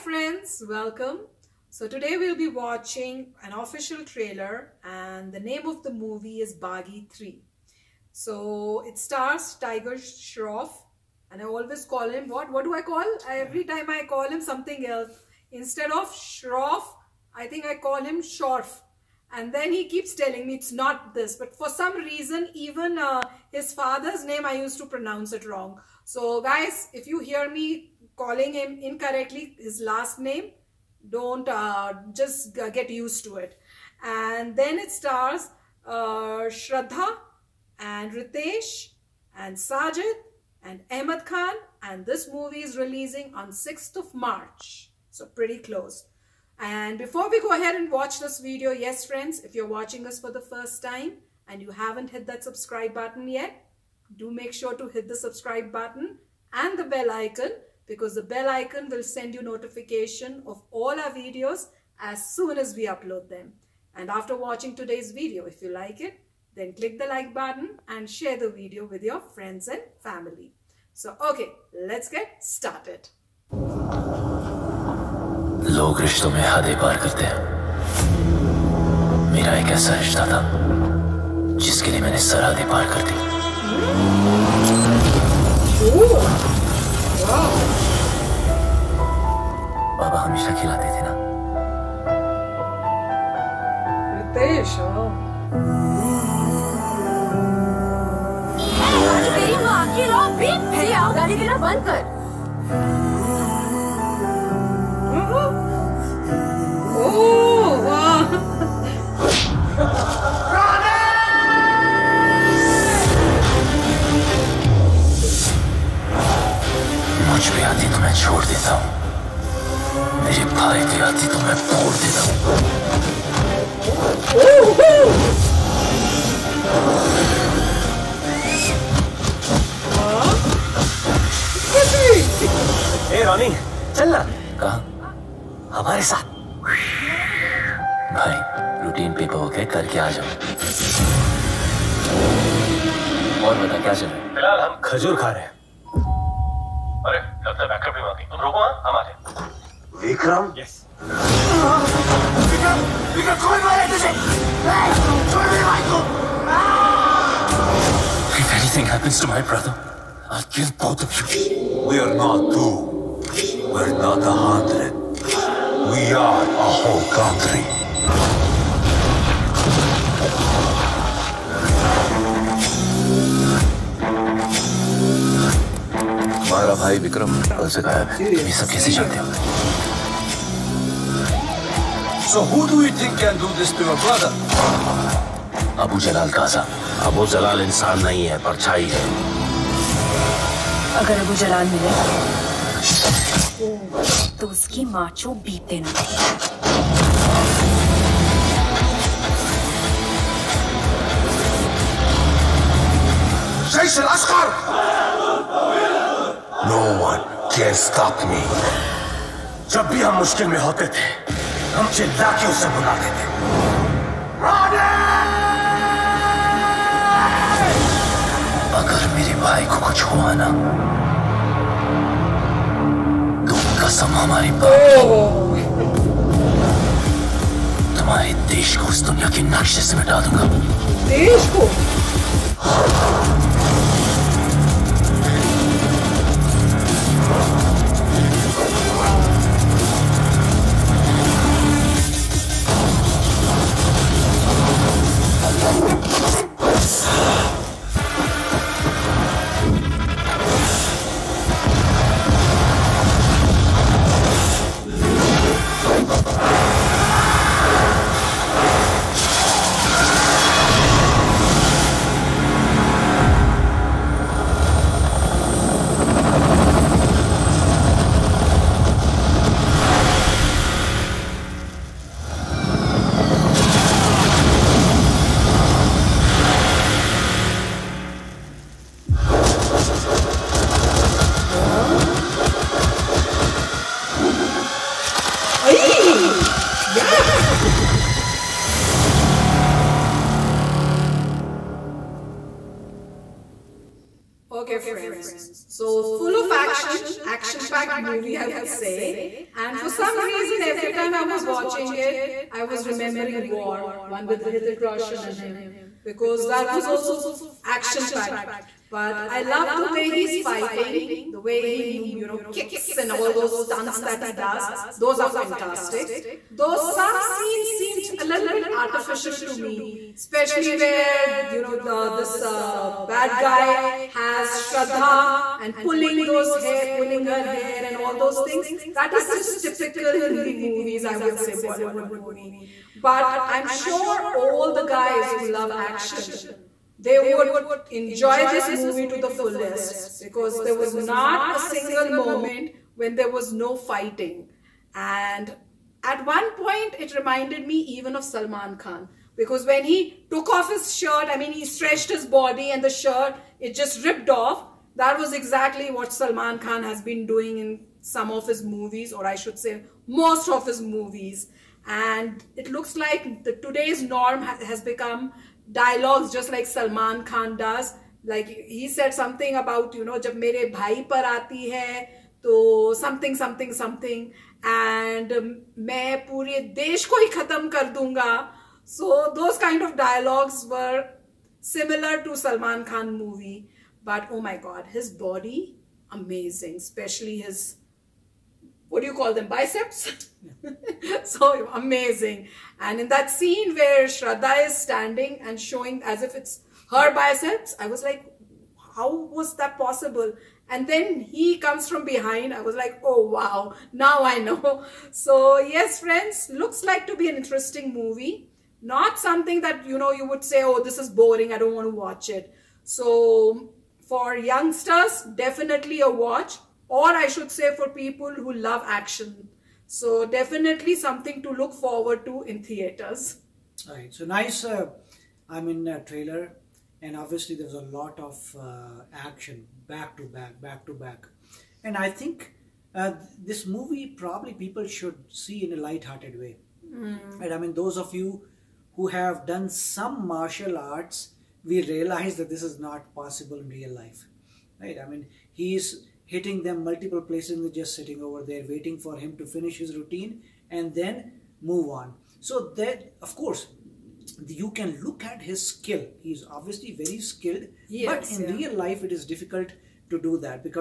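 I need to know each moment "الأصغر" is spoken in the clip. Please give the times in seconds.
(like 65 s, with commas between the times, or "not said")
204 s.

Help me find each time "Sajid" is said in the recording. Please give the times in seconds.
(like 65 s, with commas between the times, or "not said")
39 s.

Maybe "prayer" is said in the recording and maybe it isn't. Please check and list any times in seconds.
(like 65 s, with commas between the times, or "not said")
not said.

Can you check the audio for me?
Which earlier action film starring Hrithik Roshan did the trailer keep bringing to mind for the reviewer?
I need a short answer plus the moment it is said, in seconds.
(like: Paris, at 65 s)
War, at 303 s.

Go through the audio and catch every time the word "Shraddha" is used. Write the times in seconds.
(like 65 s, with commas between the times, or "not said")
36 s, 324 s, 394 s.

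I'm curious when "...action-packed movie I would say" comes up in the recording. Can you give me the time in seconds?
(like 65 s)
297 s.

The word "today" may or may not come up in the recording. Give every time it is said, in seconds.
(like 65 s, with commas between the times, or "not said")
1 s, 64 s, 363 s.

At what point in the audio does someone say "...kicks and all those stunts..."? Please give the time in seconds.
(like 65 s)
312 s.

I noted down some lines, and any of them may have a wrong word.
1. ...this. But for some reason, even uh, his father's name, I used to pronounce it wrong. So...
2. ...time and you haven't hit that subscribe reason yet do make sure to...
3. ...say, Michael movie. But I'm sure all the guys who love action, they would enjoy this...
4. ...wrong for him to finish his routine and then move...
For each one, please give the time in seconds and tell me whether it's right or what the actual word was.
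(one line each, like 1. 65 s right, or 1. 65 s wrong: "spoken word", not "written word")
1. 21 s right
2. 50 s wrong: "button", not "reason"
3. 331 s wrong: "Bollywood", not "Michael"
4. 448 s wrong: "waiting", not "wrong".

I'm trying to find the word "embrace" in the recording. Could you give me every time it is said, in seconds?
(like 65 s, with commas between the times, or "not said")
not said.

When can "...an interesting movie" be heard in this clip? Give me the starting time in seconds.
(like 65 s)
407 s.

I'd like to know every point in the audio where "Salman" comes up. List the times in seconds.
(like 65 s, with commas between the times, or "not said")
348 s, 356 s, 366 s, 382 s.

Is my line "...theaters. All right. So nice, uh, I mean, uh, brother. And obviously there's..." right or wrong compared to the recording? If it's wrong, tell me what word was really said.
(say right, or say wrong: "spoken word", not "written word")
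wrong: "trailer", not "brother".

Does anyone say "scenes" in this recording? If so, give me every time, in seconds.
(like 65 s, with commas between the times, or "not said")
317 s, 393 s.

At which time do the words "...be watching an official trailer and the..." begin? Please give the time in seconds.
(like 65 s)
2 s.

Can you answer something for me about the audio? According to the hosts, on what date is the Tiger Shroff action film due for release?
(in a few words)
6th of March.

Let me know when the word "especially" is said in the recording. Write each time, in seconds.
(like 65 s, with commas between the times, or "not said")
320 s, 386 s.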